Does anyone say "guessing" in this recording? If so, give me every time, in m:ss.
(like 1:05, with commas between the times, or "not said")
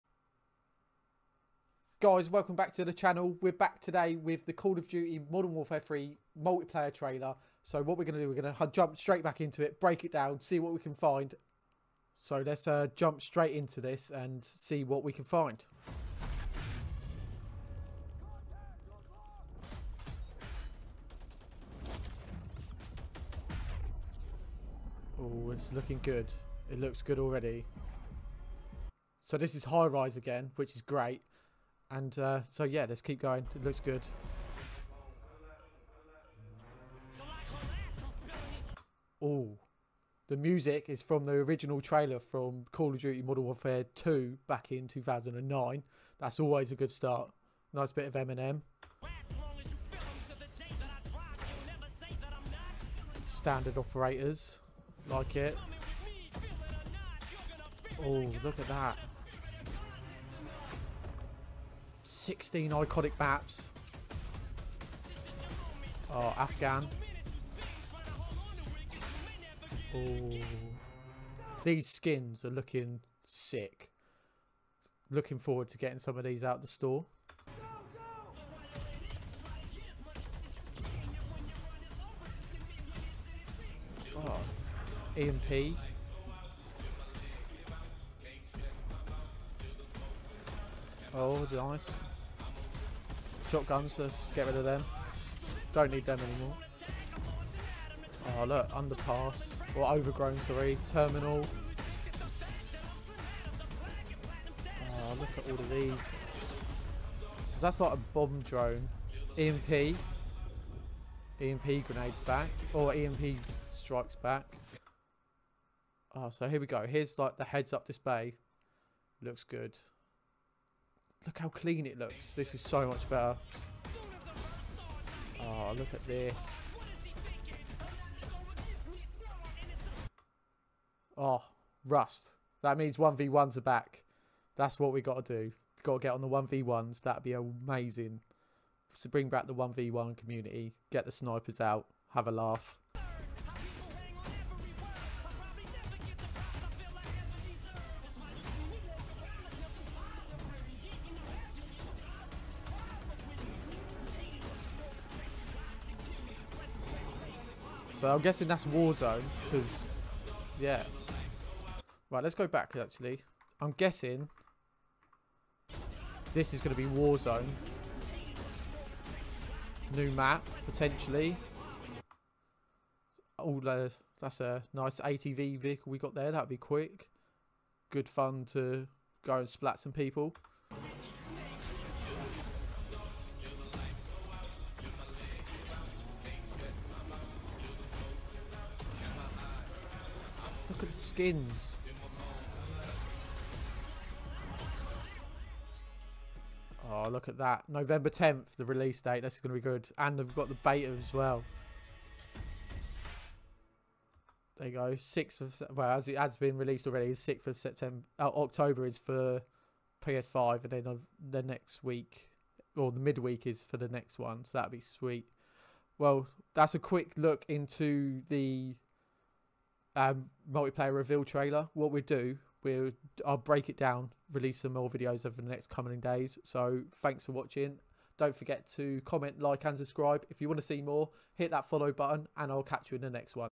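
2:38, 2:43.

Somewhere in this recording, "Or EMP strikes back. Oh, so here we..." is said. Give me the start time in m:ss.
1:52.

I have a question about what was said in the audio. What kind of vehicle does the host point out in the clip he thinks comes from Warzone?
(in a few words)
ATV.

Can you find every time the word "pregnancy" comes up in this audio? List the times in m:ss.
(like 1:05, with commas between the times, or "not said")
not said.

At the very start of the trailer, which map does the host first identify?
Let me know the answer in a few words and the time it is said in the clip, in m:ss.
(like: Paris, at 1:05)
High Rise, at 0:29.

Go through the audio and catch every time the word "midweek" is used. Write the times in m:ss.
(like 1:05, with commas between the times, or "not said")
3:33.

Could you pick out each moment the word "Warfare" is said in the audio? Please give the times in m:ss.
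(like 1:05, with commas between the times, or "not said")
0:05, 0:43.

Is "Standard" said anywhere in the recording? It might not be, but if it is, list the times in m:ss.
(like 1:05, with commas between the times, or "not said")
0:53.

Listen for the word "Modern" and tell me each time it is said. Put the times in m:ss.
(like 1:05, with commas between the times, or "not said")
0:05, 0:43.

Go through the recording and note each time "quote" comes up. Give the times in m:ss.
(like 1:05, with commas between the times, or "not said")
not said.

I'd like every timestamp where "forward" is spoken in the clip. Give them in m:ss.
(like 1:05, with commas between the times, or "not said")
1:15.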